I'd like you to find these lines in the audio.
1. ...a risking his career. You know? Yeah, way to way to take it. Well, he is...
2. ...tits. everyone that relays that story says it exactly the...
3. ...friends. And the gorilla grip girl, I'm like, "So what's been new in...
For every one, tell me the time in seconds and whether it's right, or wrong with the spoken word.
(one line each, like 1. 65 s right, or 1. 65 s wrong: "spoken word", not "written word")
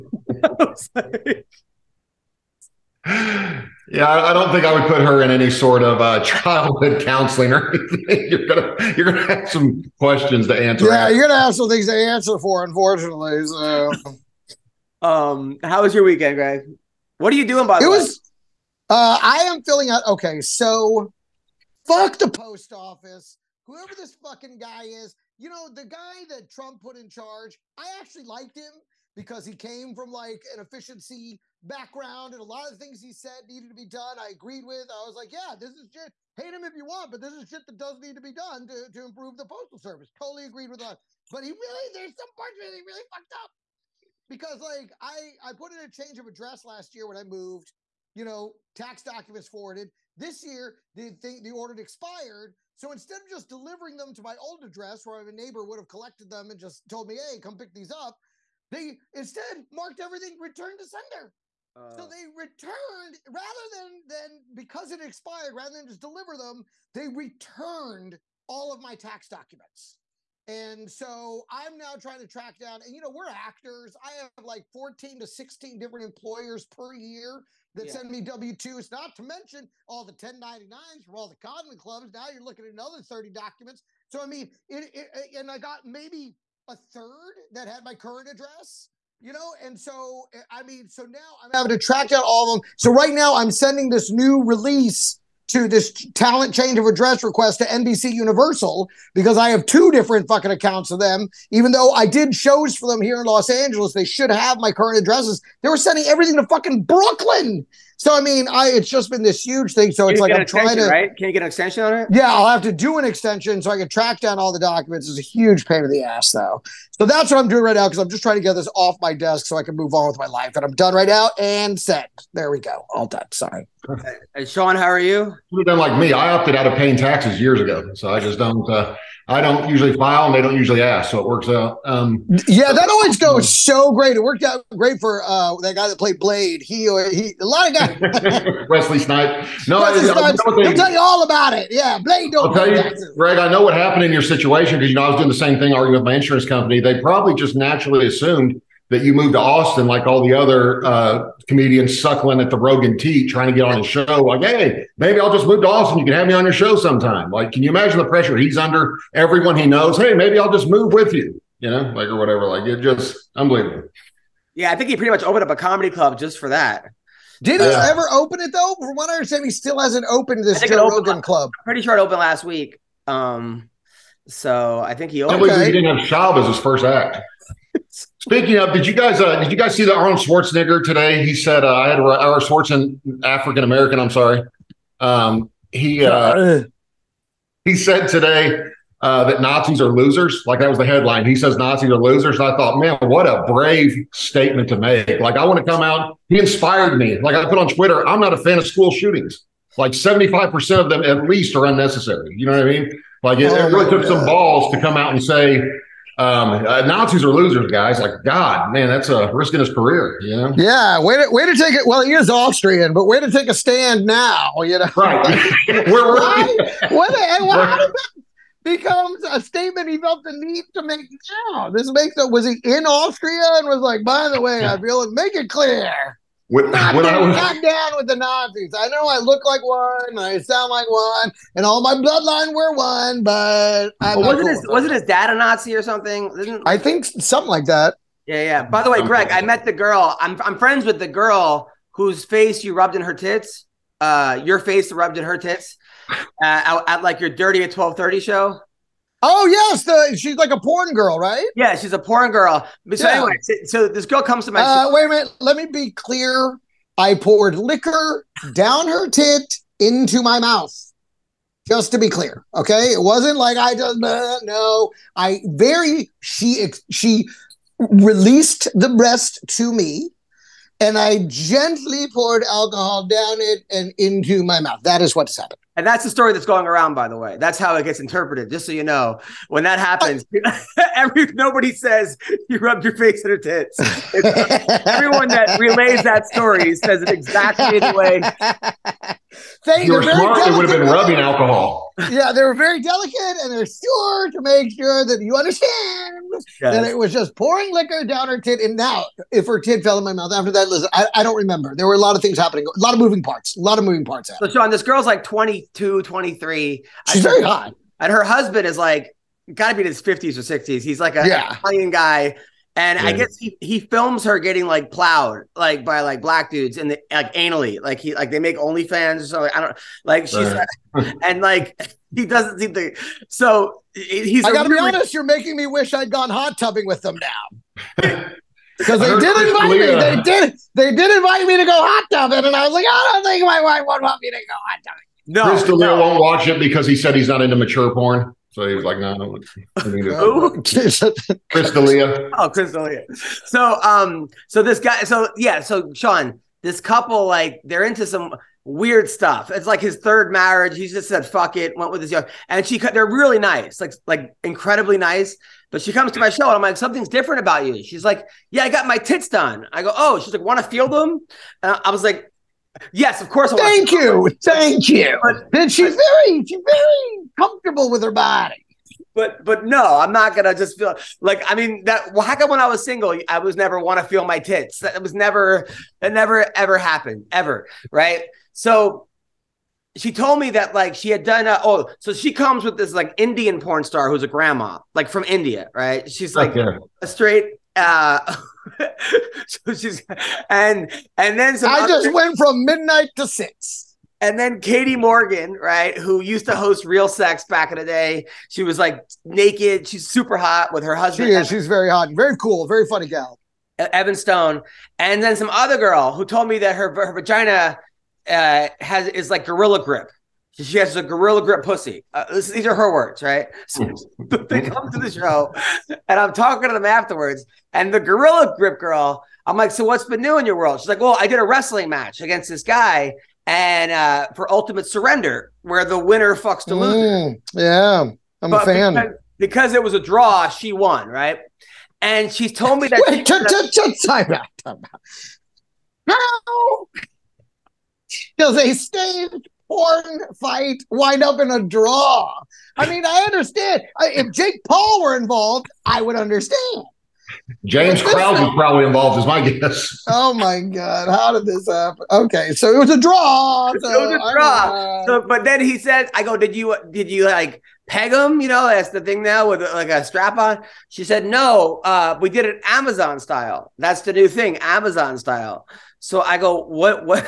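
1. 209 s right
2. 283 s right
3. 416 s wrong: "afterwards", not "friends".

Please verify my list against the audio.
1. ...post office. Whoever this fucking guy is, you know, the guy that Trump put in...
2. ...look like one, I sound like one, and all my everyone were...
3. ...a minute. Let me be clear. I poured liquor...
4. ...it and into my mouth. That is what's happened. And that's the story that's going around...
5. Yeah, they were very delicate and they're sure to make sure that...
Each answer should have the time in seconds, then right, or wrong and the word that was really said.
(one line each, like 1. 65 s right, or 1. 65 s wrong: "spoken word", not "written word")
1. 22 s right
2. 229 s wrong: "bloodline", not "everyone"
3. 255 s right
4. 273 s right
5. 292 s right.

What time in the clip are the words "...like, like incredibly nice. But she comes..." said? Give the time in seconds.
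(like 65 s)
353 s.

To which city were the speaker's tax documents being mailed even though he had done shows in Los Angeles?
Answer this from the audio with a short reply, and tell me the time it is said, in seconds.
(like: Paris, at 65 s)
Brooklyn, at 106 s.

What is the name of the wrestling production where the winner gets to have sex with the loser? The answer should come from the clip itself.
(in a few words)
Ultimate Surrender.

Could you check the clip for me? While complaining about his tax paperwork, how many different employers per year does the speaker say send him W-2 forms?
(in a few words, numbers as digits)
14 to 16.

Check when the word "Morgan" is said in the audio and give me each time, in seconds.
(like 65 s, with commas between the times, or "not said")
394 s.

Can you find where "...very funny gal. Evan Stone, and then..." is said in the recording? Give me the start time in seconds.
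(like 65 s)
402 s.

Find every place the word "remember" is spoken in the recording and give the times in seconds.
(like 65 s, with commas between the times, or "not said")
301 s.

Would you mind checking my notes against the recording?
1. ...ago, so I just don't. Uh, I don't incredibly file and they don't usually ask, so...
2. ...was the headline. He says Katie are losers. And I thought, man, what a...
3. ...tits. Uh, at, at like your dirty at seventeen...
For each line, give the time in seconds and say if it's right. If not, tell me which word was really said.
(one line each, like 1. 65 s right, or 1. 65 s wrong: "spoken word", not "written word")
1. 127 s wrong: "usually", not "incredibly"
2. 190 s wrong: "Nazis", not "Katie"
3. 245 s wrong: "twelve", not "seventeen".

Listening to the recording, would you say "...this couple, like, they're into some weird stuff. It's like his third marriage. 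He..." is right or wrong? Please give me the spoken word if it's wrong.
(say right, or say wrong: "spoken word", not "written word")
right.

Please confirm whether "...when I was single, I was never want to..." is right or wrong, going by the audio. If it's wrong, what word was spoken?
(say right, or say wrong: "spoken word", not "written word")
right.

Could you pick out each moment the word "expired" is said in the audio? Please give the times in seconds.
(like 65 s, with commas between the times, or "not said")
51 s, 65 s.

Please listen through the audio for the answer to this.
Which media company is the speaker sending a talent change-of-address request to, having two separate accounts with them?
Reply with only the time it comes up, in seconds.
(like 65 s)
97 s.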